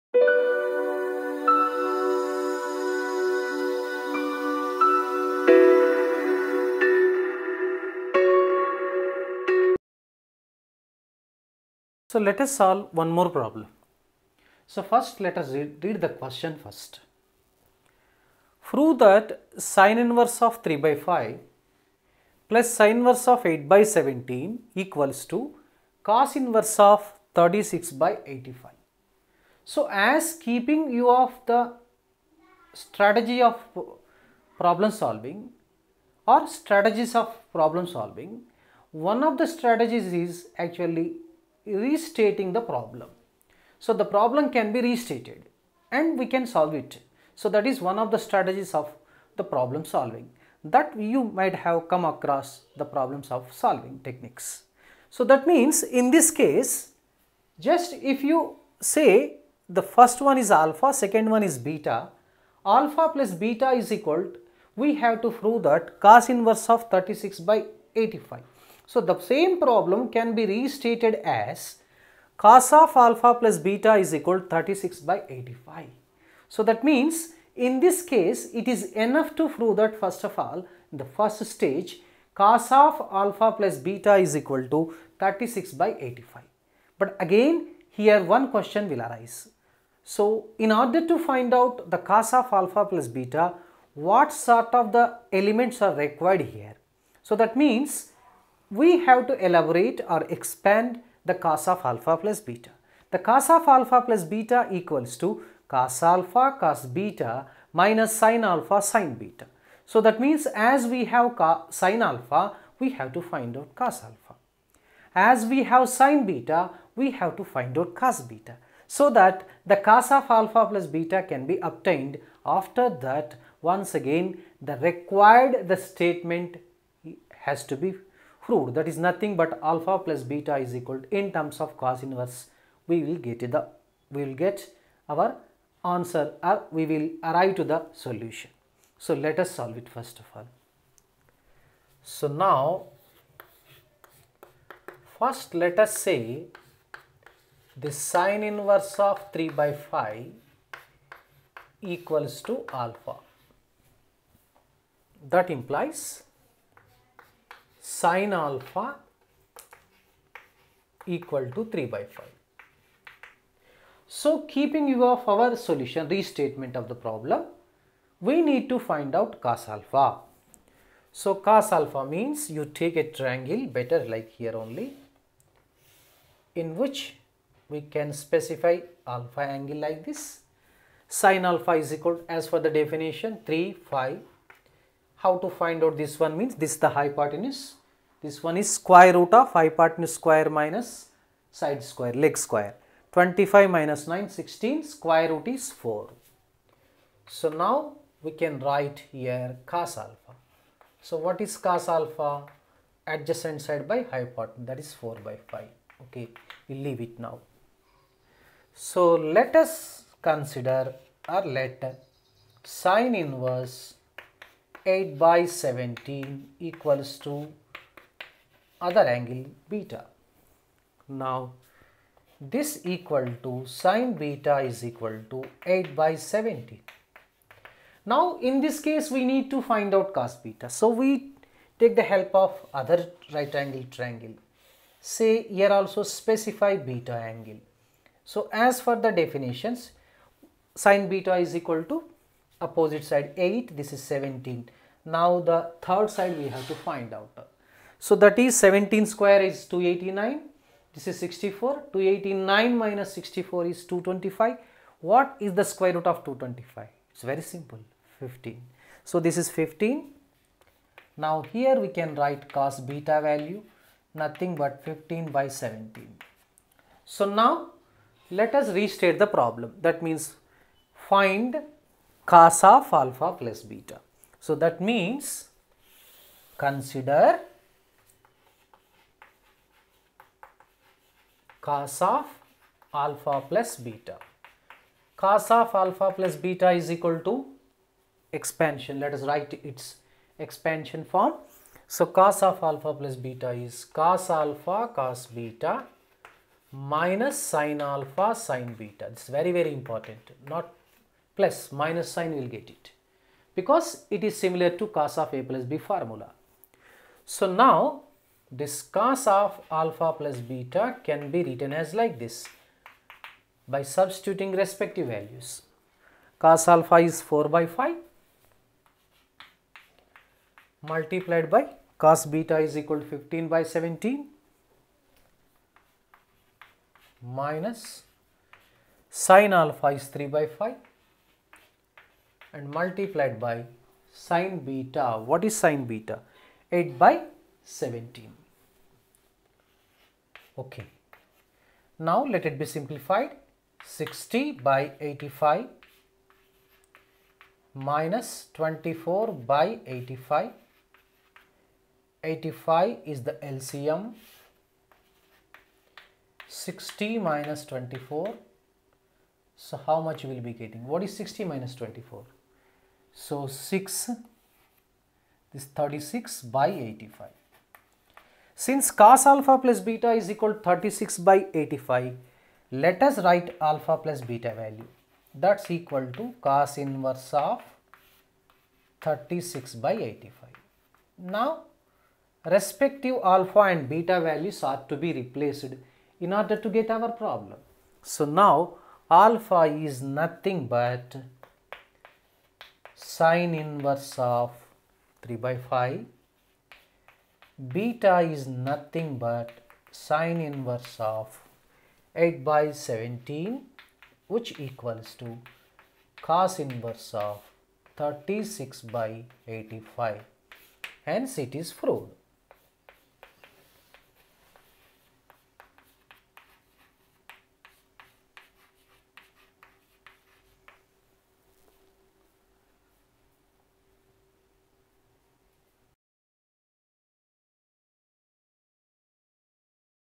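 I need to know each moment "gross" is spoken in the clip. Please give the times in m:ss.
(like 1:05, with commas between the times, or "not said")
not said.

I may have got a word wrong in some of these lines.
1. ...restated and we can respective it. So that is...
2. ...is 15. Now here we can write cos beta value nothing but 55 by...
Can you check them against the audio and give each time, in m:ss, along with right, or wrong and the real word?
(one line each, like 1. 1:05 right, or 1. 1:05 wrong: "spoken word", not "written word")
1. 0:44 wrong: "solve", not "respective"
2. 4:19 wrong: "15", not "55".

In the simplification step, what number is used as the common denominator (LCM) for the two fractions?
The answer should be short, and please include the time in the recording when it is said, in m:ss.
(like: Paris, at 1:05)
85, at 5:52.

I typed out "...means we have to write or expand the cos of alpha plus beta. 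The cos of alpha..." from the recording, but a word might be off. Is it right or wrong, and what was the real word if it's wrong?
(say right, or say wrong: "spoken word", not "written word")
wrong: "elaborate", not "write".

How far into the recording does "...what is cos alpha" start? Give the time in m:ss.
3:21.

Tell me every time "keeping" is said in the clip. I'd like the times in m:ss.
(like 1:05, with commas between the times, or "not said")
0:30, 2:44.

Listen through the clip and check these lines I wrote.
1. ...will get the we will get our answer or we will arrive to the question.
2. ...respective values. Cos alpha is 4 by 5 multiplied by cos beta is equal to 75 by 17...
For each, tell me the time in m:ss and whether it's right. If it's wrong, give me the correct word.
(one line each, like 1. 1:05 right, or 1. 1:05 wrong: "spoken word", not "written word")
1. 2:13 wrong: "solution", not "question"
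2. 5:14 wrong: "15", not "75".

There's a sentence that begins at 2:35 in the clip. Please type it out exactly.
That implies sine alpha equal to 3 by 5.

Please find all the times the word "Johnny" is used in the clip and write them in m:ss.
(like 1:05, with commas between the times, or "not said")
not said.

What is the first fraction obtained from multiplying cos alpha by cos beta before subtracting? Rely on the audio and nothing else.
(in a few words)
60/85.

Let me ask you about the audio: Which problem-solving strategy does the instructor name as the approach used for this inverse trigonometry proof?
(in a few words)
Restating the problem.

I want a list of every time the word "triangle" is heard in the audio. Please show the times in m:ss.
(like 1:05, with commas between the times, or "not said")
2:53, 3:53.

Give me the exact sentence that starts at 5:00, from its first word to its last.
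Not plus minus sign will get it because it is similar to cos of a plus b formula.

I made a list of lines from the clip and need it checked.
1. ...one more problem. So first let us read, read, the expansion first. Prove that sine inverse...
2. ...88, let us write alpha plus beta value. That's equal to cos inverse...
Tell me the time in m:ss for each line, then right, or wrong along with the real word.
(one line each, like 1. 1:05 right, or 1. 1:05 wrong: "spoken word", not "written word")
1. 0:12 wrong: "question", not "expansion"
2. 6:11 wrong: "85", not "88".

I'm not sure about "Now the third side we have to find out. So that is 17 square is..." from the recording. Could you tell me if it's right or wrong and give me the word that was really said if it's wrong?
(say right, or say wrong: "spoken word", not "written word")
right.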